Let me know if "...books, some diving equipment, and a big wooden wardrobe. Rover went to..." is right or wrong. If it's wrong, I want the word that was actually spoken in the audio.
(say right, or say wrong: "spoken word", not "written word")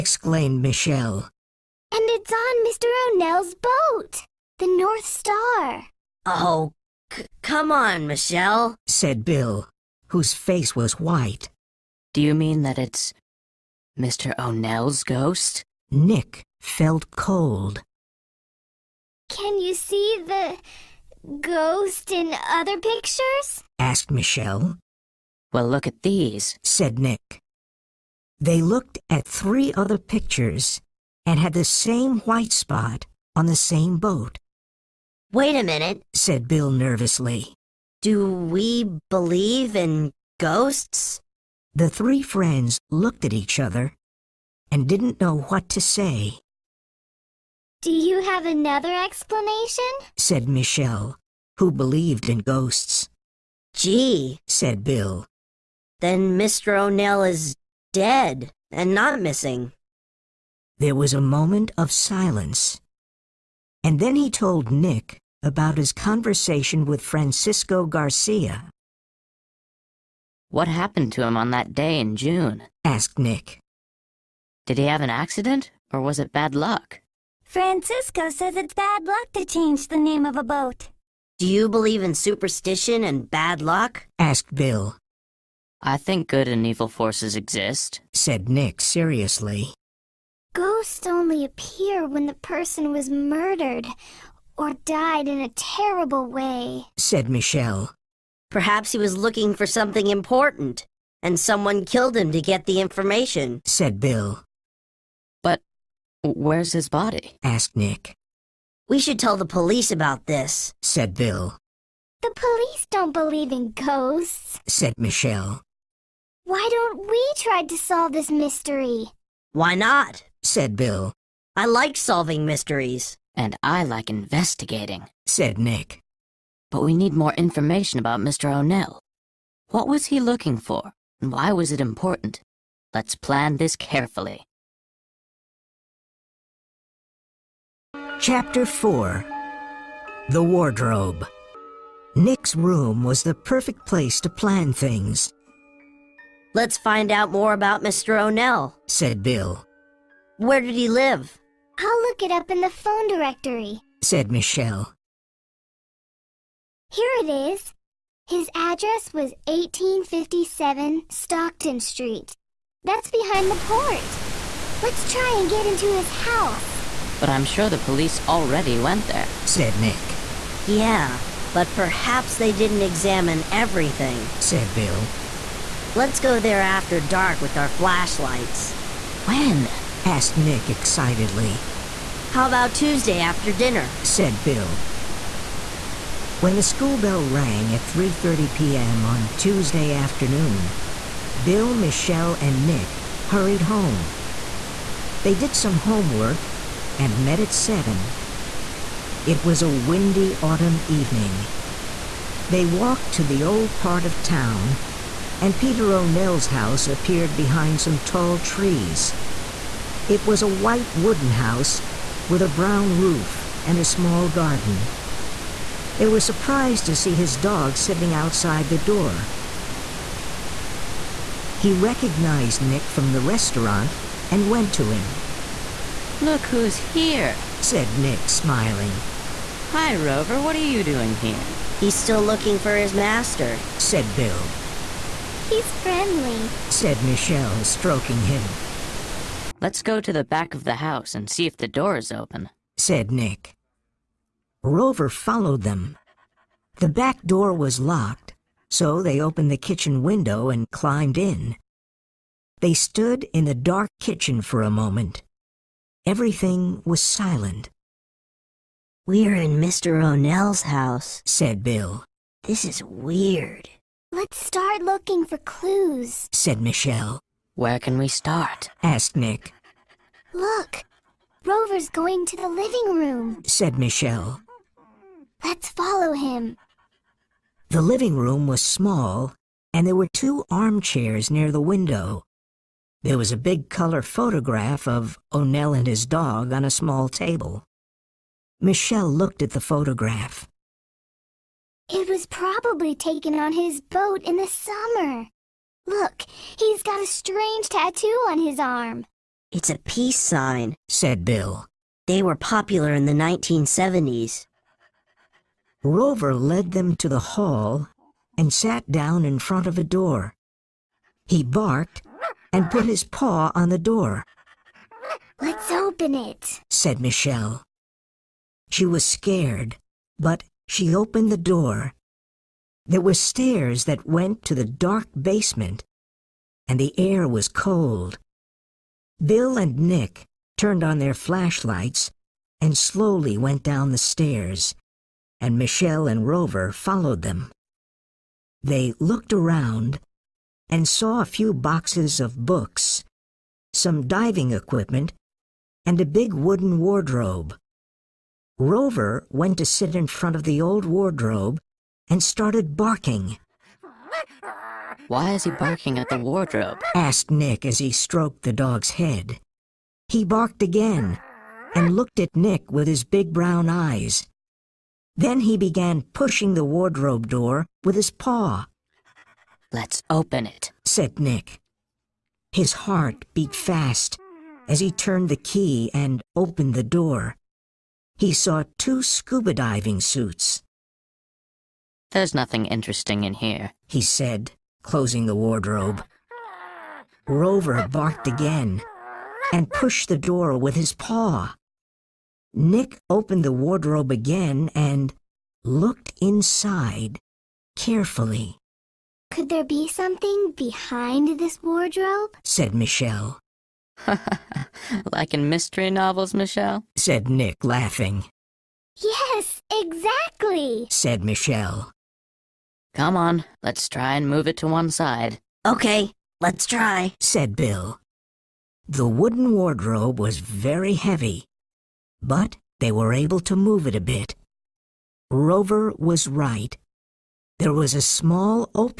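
right.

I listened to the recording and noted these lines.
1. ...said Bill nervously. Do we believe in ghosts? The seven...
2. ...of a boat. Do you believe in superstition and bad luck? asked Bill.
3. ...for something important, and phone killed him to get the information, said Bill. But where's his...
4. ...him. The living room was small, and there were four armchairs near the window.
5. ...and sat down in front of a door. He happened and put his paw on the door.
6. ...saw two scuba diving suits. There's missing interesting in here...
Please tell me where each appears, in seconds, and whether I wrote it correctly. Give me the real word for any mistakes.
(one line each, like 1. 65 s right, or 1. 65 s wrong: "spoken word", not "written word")
1. 36 s wrong: "three", not "seven"
2. 80 s right
3. 99 s wrong: "someone", not "phone"
4. 276 s wrong: "two", not "four"
5. 308 s wrong: "barked", not "happened"
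6. 378 s wrong: "nothing", not "missing".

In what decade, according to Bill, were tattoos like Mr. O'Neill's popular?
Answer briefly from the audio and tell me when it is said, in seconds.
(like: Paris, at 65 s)
1970s, at 303 s.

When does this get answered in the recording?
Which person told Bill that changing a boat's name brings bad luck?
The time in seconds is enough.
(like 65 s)
67 s.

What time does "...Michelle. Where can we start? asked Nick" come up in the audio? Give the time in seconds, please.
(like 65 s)
266 s.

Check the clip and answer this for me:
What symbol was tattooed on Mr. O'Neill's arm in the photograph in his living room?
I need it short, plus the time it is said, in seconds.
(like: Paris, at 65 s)
Peace sign, at 299 s.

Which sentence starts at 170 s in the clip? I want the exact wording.
Yeah, but perhaps they didn't examine everything, said Bill.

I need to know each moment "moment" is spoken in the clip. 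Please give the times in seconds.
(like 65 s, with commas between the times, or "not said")
61 s, 254 s.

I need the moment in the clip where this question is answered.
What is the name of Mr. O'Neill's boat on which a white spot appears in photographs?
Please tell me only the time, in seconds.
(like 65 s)
4 s.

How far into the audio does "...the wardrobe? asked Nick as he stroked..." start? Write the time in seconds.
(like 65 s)
356 s.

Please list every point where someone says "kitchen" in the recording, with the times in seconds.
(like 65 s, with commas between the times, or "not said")
249 s, 254 s.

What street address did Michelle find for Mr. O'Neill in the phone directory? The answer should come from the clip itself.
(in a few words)
1857 Stockton Street.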